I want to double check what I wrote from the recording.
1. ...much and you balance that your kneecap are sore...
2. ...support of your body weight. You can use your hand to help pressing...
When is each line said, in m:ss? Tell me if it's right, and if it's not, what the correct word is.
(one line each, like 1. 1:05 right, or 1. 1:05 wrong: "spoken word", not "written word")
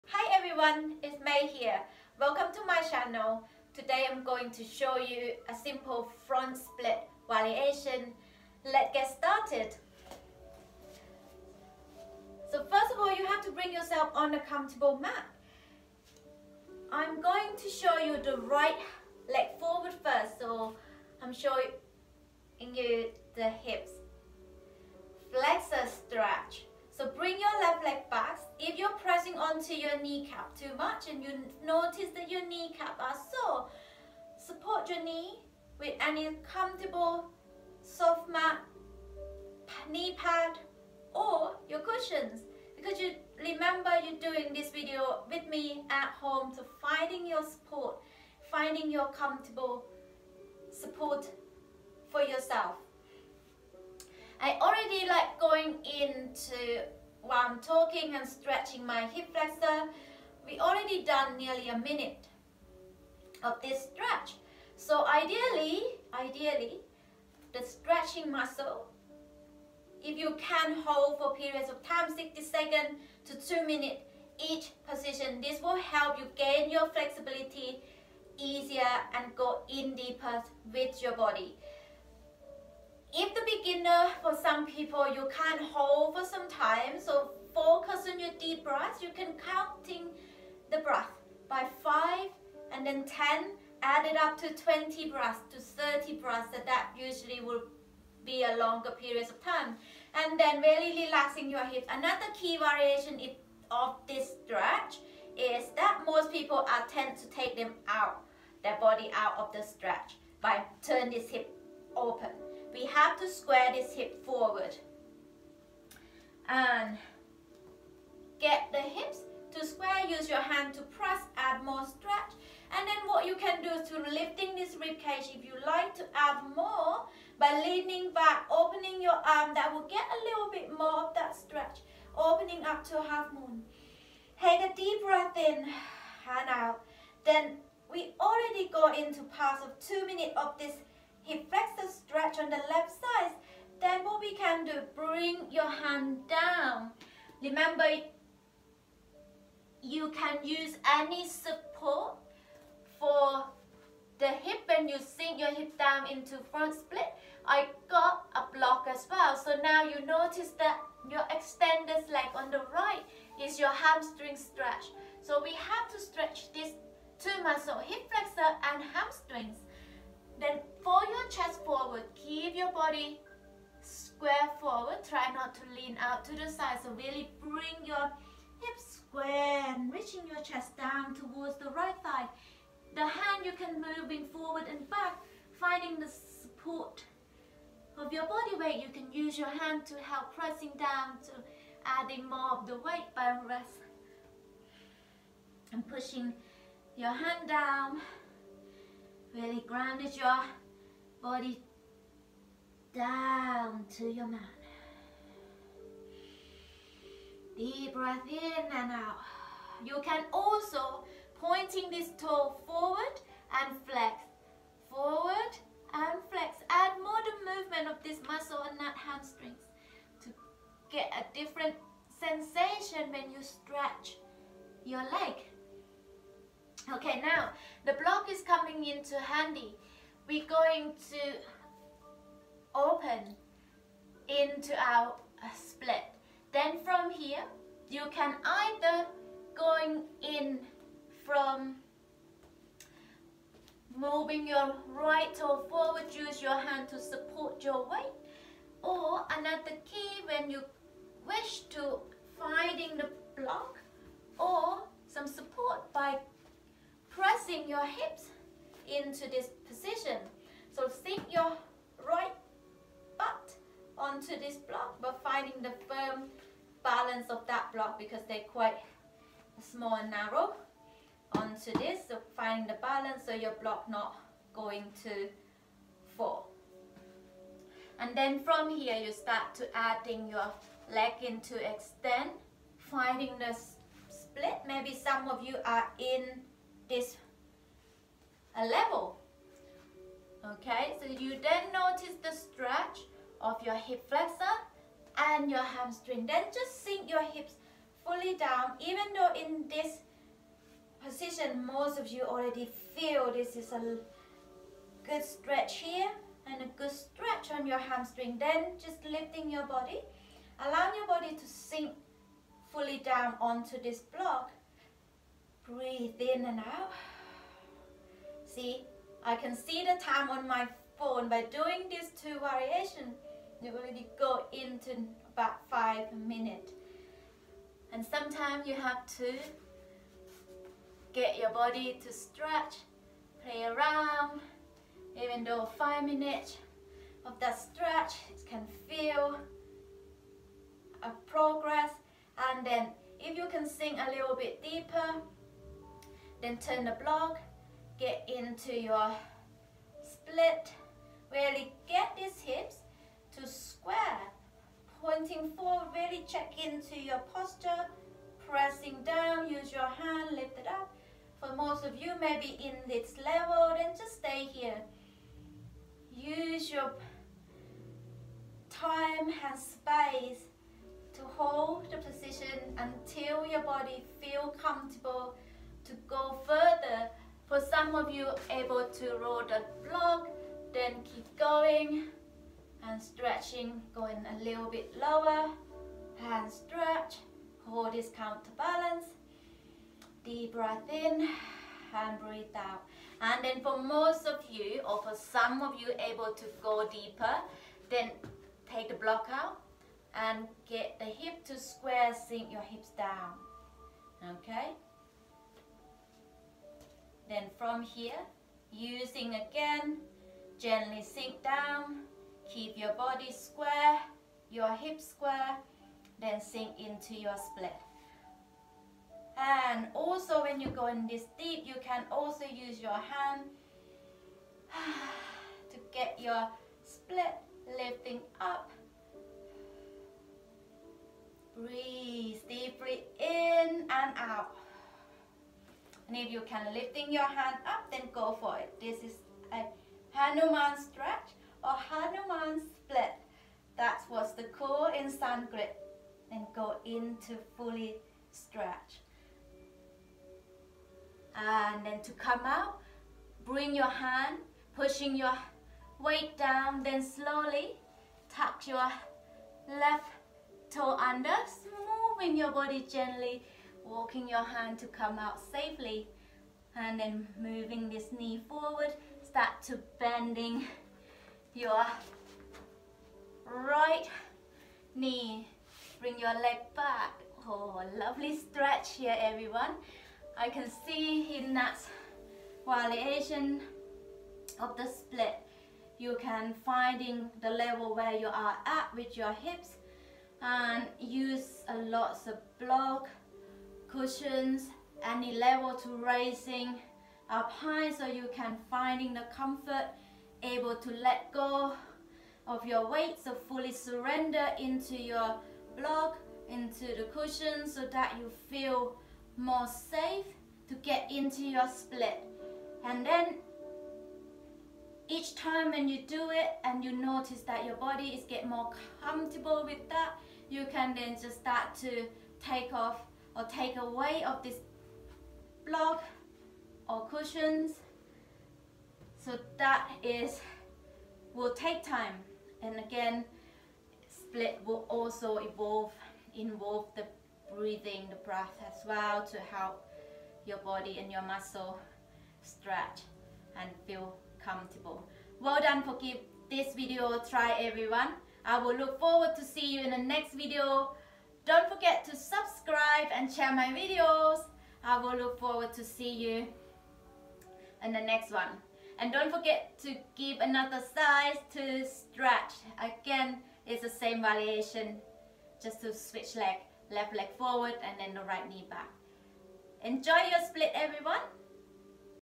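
1. 0:30 wrong: "notice", not "balance"
2. 3:06 right.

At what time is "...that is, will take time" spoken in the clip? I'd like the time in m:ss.
8:49.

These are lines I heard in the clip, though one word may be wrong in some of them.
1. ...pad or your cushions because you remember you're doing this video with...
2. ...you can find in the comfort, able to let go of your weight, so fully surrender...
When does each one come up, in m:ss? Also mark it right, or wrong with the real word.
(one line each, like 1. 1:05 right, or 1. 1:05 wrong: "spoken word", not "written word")
1. 0:40 right
2. 8:18 right.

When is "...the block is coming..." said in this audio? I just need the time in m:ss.
3:47.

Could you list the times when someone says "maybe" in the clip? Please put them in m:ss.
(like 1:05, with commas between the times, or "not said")
4:44, 6:02.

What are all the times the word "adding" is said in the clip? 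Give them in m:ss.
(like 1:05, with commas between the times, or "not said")
3:11, 4:39.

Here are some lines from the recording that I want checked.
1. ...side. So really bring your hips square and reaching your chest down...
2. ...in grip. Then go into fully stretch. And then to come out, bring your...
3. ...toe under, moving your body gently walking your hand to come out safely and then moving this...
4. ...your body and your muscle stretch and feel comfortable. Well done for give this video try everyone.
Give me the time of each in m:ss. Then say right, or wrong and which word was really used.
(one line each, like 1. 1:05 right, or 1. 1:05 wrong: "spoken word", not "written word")
1. 2:56 right
2. 7:24 right
3. 7:40 right
4. 9:00 right.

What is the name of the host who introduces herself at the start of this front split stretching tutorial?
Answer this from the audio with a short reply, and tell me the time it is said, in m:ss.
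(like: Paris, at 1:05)
May, at 0:01.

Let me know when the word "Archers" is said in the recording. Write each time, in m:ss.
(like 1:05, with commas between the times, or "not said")
not said.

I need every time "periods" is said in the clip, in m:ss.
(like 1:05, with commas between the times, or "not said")
1:11, 1:38.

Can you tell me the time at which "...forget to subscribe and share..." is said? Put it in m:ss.
9:11.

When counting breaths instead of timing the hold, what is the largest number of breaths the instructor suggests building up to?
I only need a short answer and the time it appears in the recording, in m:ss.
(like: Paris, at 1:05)
30 breaths, at 1:35.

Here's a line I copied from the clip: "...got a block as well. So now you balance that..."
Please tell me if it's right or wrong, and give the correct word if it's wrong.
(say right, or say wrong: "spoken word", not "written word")
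wrong: "notice", not "balance".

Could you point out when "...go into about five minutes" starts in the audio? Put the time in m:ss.
5:24.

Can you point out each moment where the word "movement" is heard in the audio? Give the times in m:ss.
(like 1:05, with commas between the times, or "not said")
3:37.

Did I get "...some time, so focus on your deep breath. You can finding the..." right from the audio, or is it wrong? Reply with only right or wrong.
wrong.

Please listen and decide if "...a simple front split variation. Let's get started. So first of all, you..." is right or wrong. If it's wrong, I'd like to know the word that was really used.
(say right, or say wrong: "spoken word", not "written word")
right.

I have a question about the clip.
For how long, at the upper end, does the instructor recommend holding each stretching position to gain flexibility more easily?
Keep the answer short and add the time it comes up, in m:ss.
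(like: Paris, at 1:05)
2 minutes, at 1:13.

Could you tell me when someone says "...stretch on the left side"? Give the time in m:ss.
2:21.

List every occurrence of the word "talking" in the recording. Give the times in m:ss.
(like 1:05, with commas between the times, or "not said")
0:57.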